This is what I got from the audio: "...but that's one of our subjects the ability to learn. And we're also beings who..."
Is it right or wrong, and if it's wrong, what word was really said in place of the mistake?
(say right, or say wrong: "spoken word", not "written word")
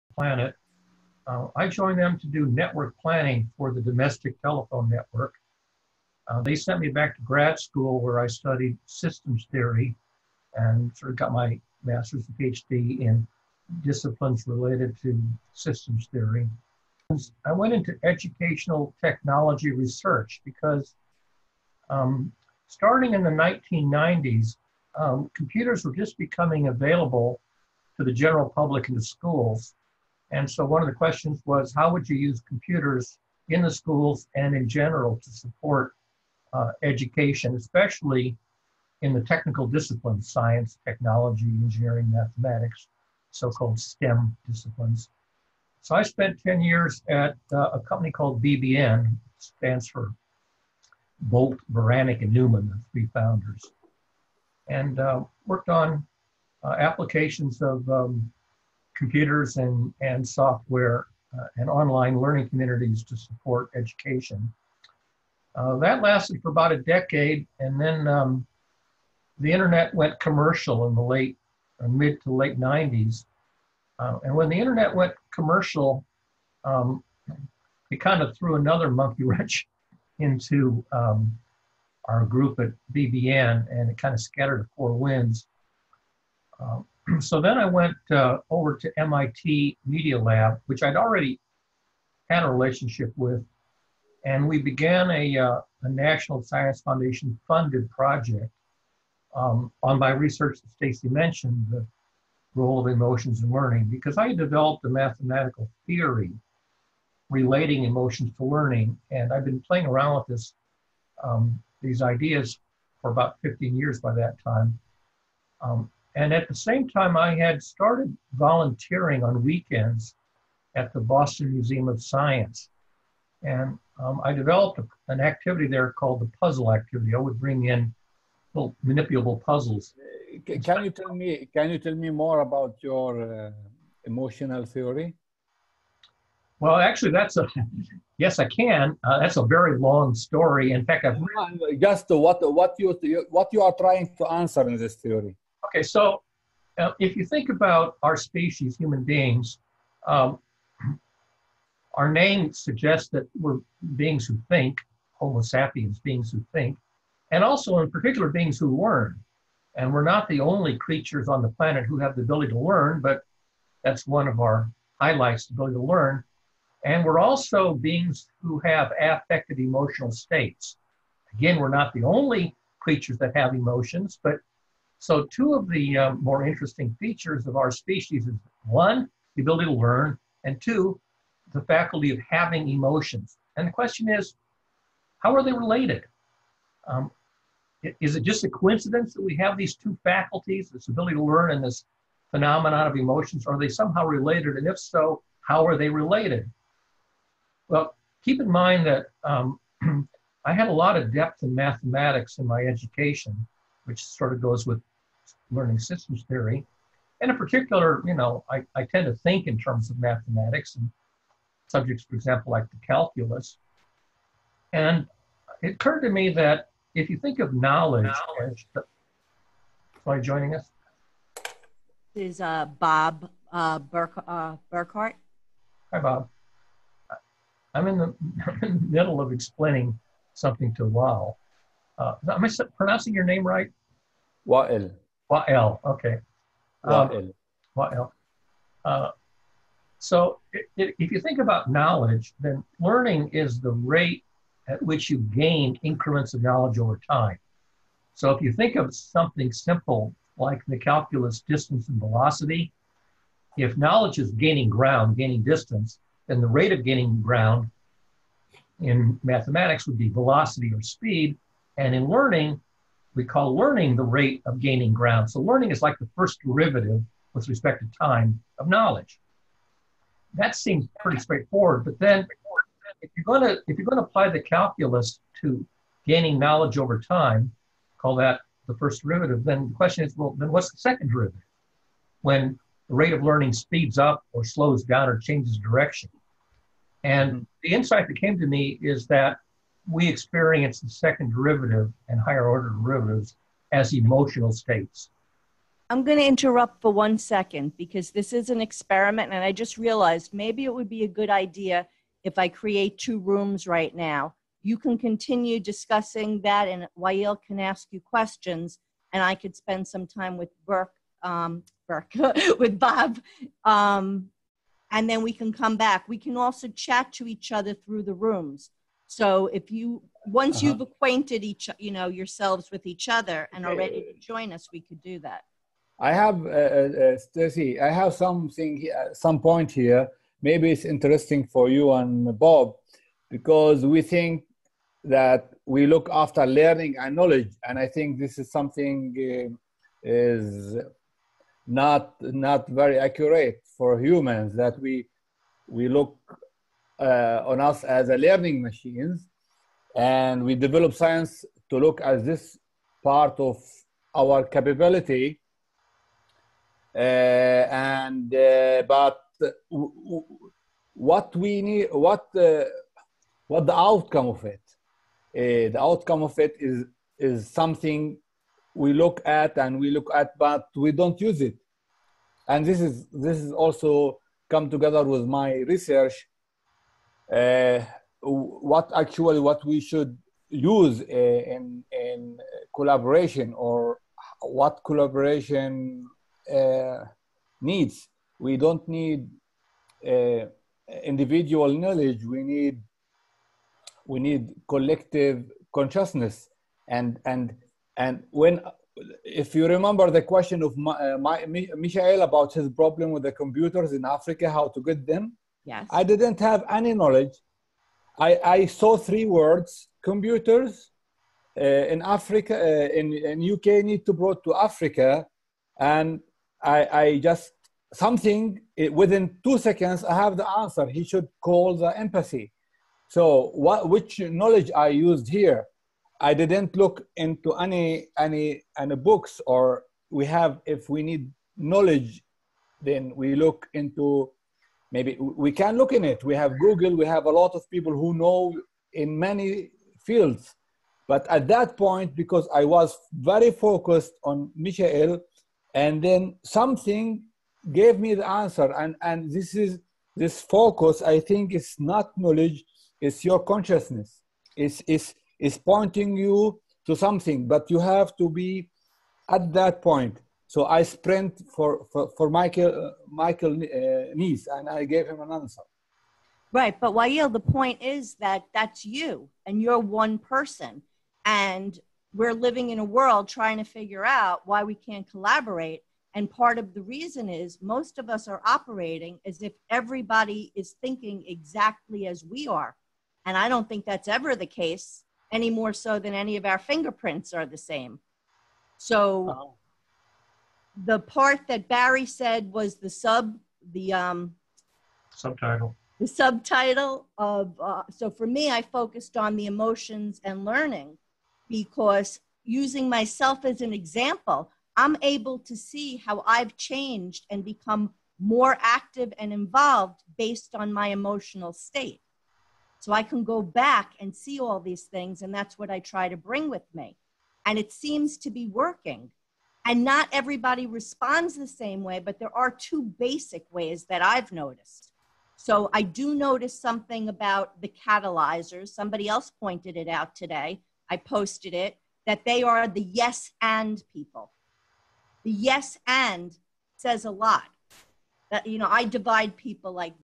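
wrong: "highlights", not "subjects".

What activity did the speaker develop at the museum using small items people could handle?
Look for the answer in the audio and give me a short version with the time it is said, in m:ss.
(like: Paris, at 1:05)
The puzzle activity, at 2:06.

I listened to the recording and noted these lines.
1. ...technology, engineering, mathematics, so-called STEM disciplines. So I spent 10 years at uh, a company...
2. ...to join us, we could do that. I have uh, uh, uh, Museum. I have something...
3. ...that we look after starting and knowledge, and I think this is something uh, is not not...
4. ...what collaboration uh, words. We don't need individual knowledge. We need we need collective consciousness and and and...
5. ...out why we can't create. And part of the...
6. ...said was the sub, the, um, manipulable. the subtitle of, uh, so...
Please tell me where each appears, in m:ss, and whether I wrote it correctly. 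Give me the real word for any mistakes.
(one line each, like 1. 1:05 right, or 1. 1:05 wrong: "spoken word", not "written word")
1. 0:40 right
2. 5:24 wrong: "Stacey", not "Museum"
3. 5:35 wrong: "learning", not "starting"
4. 6:24 wrong: "needs", not "words"
5. 7:54 wrong: "collaborate", not "create"
6. 8:12 wrong: "subtitle", not "manipulable".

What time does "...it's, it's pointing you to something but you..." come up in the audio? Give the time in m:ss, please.
7:34.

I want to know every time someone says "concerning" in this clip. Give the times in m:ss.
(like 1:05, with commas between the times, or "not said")
not said.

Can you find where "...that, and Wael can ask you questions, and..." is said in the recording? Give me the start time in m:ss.
5:06.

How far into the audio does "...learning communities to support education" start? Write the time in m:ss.
1:02.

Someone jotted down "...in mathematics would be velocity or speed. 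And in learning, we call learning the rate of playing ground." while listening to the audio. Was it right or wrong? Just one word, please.
wrong.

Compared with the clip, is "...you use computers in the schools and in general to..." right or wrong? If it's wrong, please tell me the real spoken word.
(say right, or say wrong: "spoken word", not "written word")
right.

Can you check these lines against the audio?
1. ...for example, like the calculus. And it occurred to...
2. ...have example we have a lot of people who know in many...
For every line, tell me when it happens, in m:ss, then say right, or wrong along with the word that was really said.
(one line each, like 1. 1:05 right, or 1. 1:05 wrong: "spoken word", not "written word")
1. 3:32 right
2. 7:16 wrong: "google", not "example".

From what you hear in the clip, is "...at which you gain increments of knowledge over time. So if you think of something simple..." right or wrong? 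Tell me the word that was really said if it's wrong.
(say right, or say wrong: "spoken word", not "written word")
right.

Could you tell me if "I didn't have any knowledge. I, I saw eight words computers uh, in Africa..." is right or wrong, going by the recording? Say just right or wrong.
wrong.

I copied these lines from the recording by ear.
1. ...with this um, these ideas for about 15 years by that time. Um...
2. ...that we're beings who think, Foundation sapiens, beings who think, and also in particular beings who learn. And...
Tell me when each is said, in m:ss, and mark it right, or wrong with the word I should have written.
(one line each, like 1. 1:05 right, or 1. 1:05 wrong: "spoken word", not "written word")
1. 1:50 right
2. 2:33 wrong: "Homo", not "Foundation".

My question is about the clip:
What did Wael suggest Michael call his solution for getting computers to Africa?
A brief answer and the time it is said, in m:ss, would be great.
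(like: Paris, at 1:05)
The empathy, at 7:01.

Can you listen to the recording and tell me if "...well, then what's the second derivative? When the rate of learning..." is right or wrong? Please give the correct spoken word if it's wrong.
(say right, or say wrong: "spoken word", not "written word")
right.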